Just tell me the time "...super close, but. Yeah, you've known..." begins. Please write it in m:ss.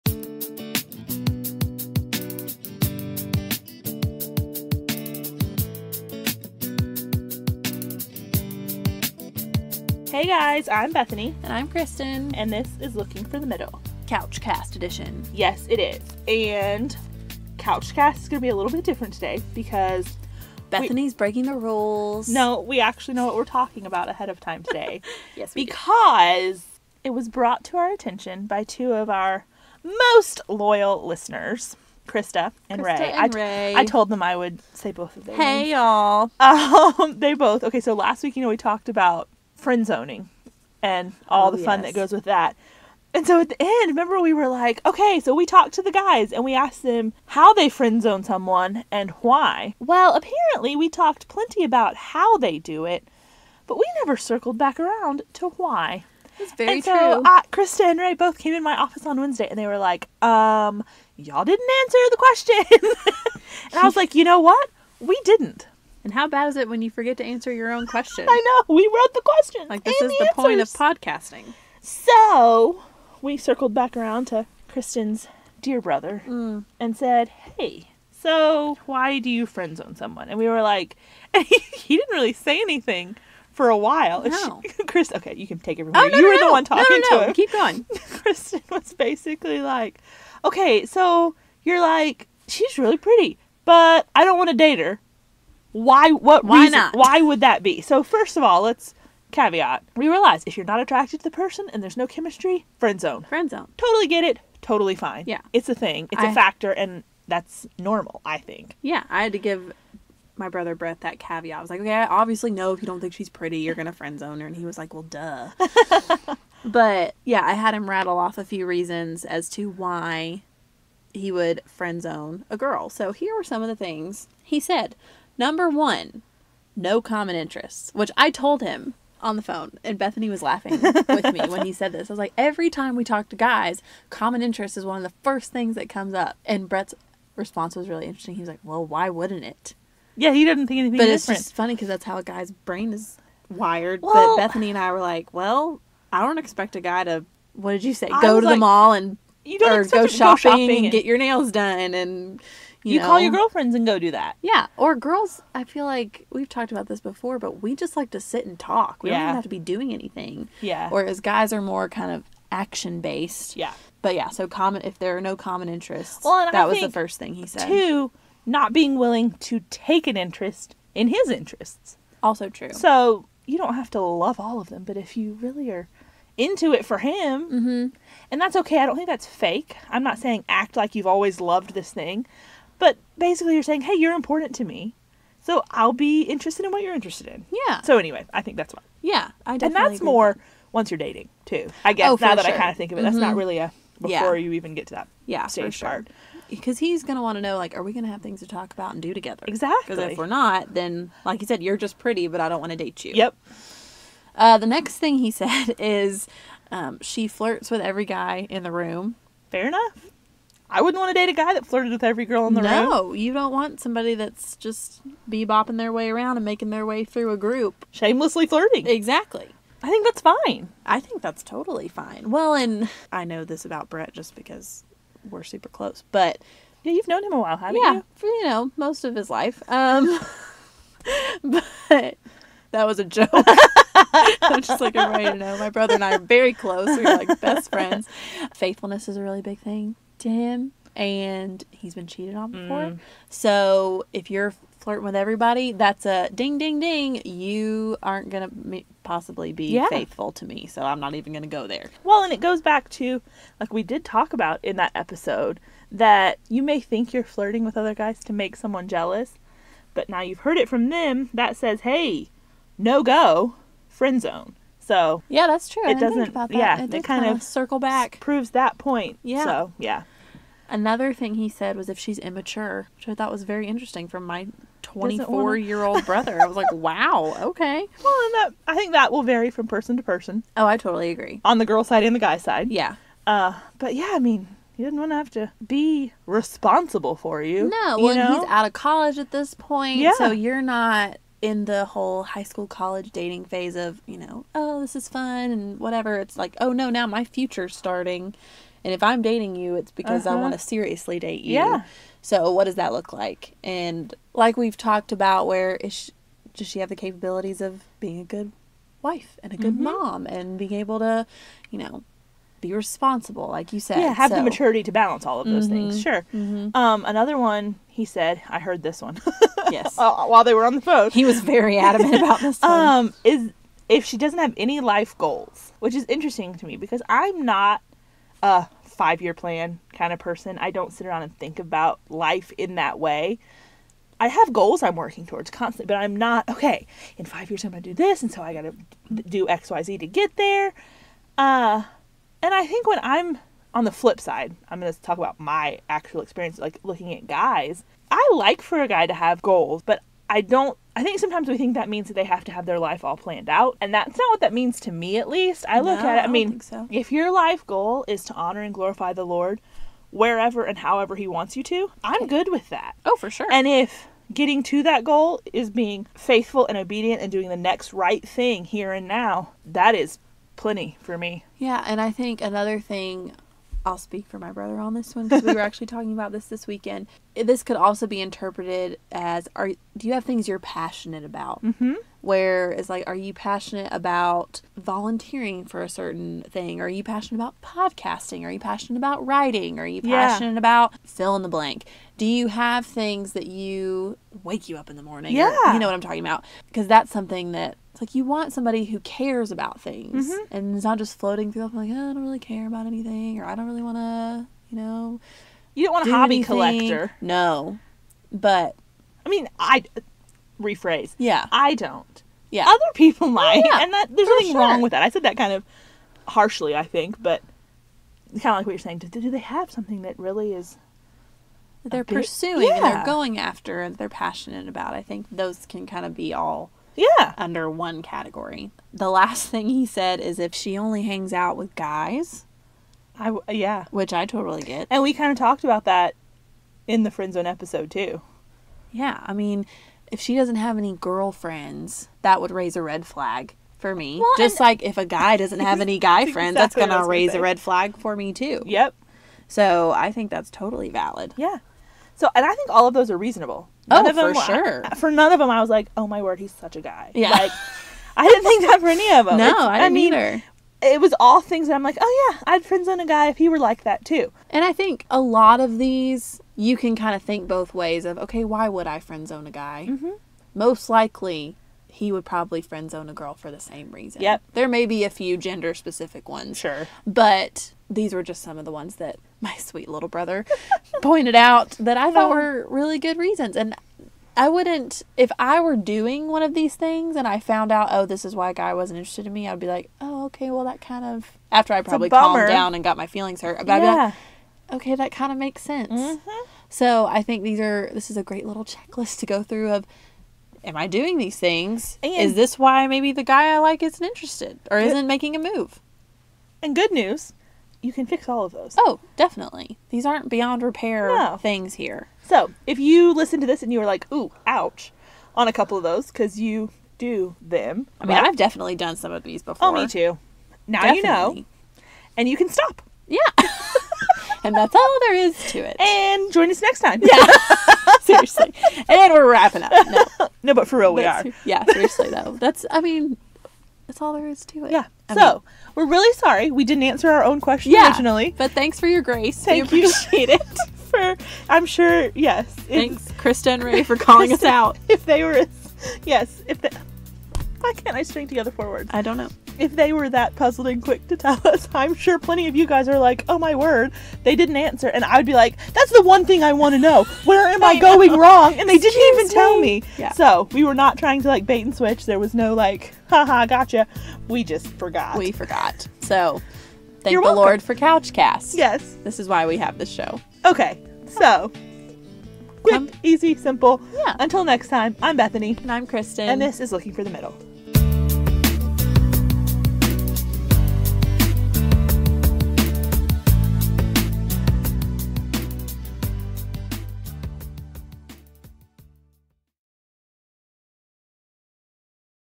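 3:45.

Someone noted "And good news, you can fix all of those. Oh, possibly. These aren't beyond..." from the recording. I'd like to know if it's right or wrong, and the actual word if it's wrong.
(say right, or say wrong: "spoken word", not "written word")
wrong: "definitely", not "possibly".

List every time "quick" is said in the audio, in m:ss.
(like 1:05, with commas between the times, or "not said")
9:10, 9:32.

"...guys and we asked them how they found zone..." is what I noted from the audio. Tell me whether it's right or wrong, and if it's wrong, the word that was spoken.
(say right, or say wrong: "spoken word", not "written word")
wrong: "friend", not "found".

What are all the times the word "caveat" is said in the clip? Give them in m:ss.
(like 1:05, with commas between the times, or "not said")
1:39, 1:51.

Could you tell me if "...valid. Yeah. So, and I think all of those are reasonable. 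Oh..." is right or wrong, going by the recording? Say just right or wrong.
right.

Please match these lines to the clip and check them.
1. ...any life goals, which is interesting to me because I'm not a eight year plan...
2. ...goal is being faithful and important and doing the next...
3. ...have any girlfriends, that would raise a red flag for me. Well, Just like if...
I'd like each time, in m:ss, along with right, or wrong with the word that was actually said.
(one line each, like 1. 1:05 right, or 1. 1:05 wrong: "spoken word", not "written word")
1. 5:24 wrong: "five", not "eight"
2. 6:05 wrong: "obedient", not "important"
3. 7:20 right.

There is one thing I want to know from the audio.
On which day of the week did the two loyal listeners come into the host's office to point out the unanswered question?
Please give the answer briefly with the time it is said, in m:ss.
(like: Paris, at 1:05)
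Wednesday, at 0:59.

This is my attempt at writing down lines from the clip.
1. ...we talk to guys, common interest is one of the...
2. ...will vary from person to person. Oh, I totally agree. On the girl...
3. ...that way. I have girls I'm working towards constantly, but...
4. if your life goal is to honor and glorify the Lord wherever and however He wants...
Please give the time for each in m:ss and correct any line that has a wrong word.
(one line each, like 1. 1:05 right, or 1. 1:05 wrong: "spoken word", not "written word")
1. 2:12 right
2. 4:39 right
3. 5:32 wrong: "goals", not "girls"
4. 5:56 right.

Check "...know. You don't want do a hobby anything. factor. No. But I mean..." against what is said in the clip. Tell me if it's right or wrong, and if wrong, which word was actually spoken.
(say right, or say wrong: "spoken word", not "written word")
wrong: "collector", not "factor".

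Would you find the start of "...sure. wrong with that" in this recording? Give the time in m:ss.
6:54.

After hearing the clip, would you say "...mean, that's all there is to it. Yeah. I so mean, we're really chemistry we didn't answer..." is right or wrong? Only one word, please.
wrong.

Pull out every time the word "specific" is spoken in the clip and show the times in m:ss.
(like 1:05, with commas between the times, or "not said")
7:55.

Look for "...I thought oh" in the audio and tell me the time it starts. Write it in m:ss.
8:01.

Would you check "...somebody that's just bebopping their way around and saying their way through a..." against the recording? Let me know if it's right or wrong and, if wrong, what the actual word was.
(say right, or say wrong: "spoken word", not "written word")
wrong: "making", not "saying".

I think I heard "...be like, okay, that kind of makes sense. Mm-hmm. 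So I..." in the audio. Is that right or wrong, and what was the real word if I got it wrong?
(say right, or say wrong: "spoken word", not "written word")
right.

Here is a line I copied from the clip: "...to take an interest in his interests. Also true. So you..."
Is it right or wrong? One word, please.
right.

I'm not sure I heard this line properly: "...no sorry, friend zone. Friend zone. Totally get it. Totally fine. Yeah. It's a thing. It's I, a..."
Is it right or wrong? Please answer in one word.
wrong.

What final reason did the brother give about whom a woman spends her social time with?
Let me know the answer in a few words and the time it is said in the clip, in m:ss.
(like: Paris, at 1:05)
only hangs out with guys, at 7:10.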